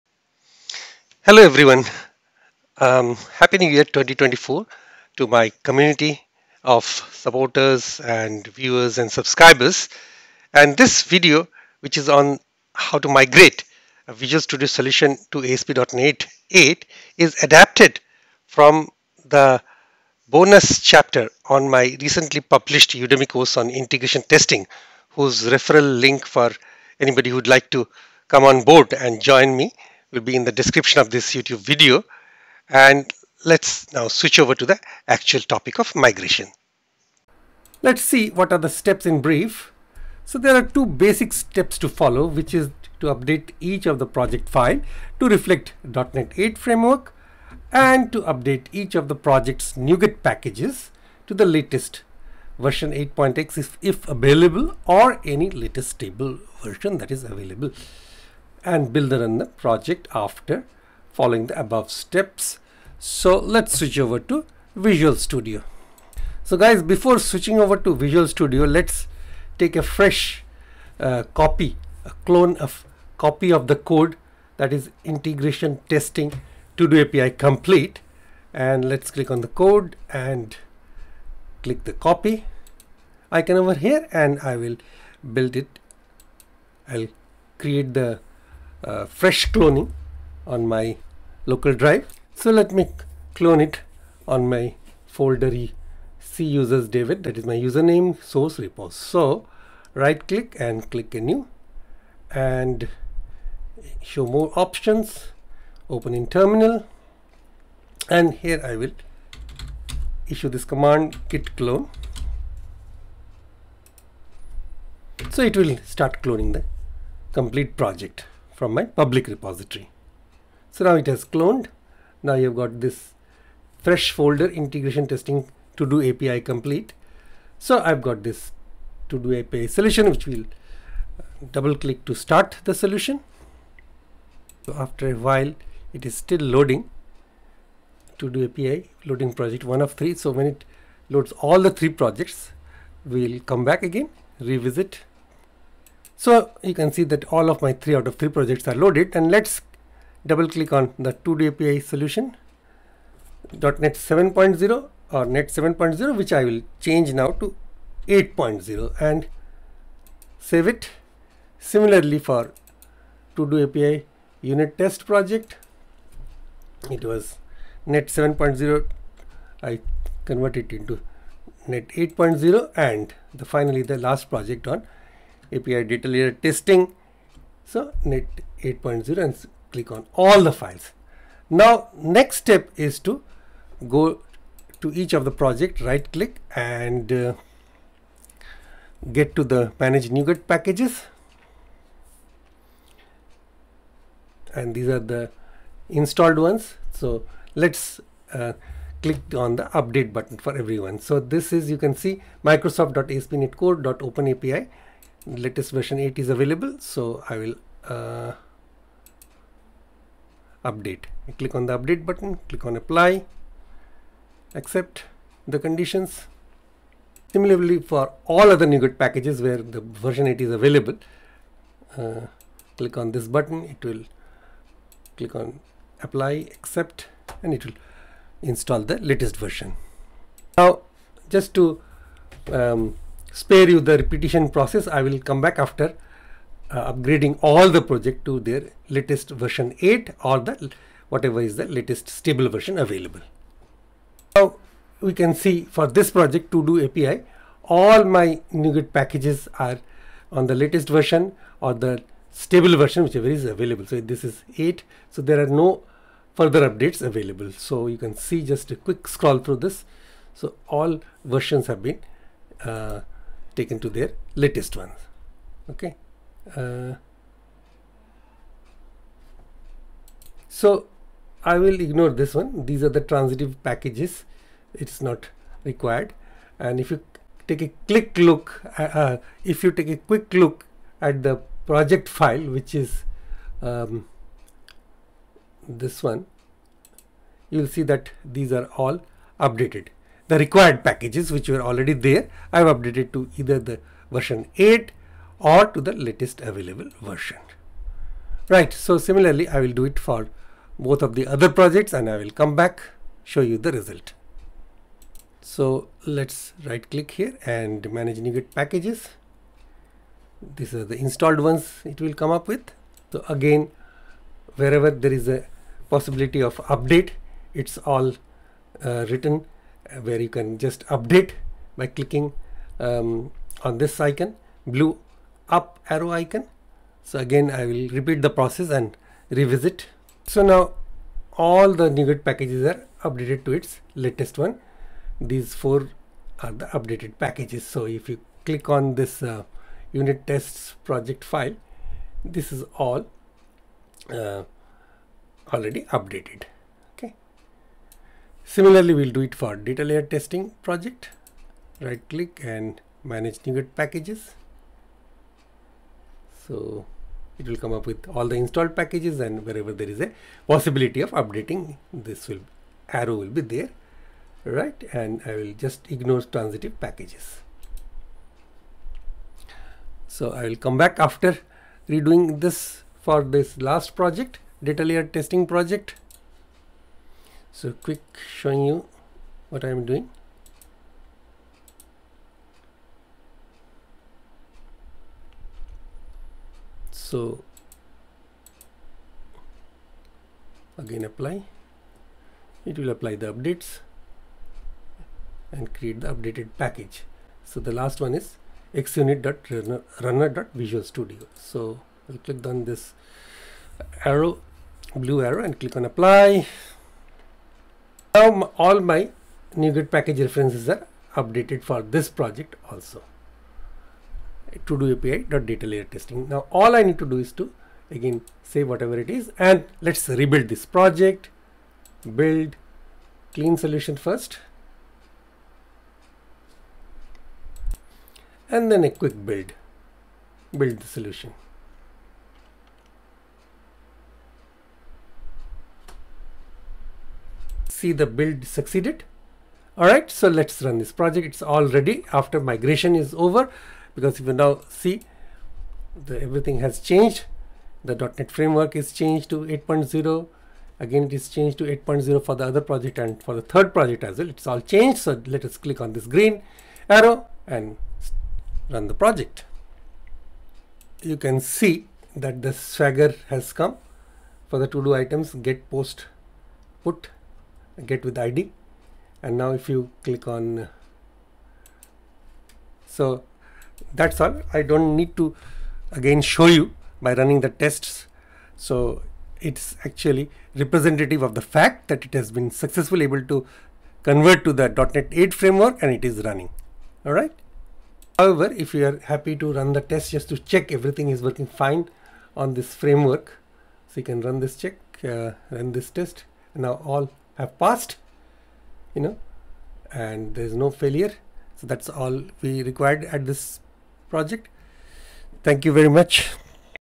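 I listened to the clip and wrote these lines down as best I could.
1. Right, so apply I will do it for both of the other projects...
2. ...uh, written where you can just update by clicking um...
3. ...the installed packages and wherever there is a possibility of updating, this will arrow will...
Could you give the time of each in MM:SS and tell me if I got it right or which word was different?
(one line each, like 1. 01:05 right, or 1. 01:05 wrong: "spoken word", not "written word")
1. 04:58 wrong: "similarly", not "apply"
2. 05:18 right
3. 05:58 right.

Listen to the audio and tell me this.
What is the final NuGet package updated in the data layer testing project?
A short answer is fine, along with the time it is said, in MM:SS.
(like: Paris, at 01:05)
xunit.runner.visualstudio, at 06:38.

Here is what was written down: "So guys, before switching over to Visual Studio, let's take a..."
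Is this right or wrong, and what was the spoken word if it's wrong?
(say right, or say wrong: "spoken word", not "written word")
right.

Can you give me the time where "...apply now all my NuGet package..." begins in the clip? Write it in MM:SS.
06:45.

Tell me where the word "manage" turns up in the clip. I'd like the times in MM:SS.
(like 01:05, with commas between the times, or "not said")
03:09, 05:07, 05:53.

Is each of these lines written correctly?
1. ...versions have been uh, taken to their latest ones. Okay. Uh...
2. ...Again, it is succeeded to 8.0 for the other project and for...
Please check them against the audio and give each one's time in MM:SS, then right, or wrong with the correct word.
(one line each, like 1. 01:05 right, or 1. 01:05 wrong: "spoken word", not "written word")
1. 04:21 right
2. 07:30 wrong: "changed", not "succeeded".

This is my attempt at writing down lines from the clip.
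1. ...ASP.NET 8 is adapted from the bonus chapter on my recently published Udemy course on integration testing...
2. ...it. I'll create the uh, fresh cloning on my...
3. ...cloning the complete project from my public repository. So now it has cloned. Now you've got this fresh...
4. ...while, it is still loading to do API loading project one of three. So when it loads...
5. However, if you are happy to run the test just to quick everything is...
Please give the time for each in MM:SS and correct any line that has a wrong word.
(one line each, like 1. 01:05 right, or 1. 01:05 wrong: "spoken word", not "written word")
1. 00:15 right
2. 01:25 right
3. 01:56 right
4. 02:15 right
5. 08:08 wrong: "check", not "quick".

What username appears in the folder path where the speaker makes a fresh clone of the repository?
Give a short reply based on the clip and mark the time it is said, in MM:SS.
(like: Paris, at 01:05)
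David, at 01:36.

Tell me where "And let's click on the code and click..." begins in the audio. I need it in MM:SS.
01:18.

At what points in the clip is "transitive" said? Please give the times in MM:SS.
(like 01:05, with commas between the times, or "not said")
04:33, 06:06.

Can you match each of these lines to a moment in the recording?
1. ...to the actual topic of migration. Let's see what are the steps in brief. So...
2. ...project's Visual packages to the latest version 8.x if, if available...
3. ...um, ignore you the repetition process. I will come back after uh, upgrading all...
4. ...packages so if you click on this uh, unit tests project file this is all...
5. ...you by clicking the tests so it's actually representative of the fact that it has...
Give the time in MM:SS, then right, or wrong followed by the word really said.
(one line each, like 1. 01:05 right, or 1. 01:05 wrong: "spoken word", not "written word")
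1. 00:34 right
2. 00:49 wrong: "NuGet", not "Visual"
3. 03:52 wrong: "spare", not "ignore"
4. 05:37 right
5. 07:56 wrong: "running", not "clicking".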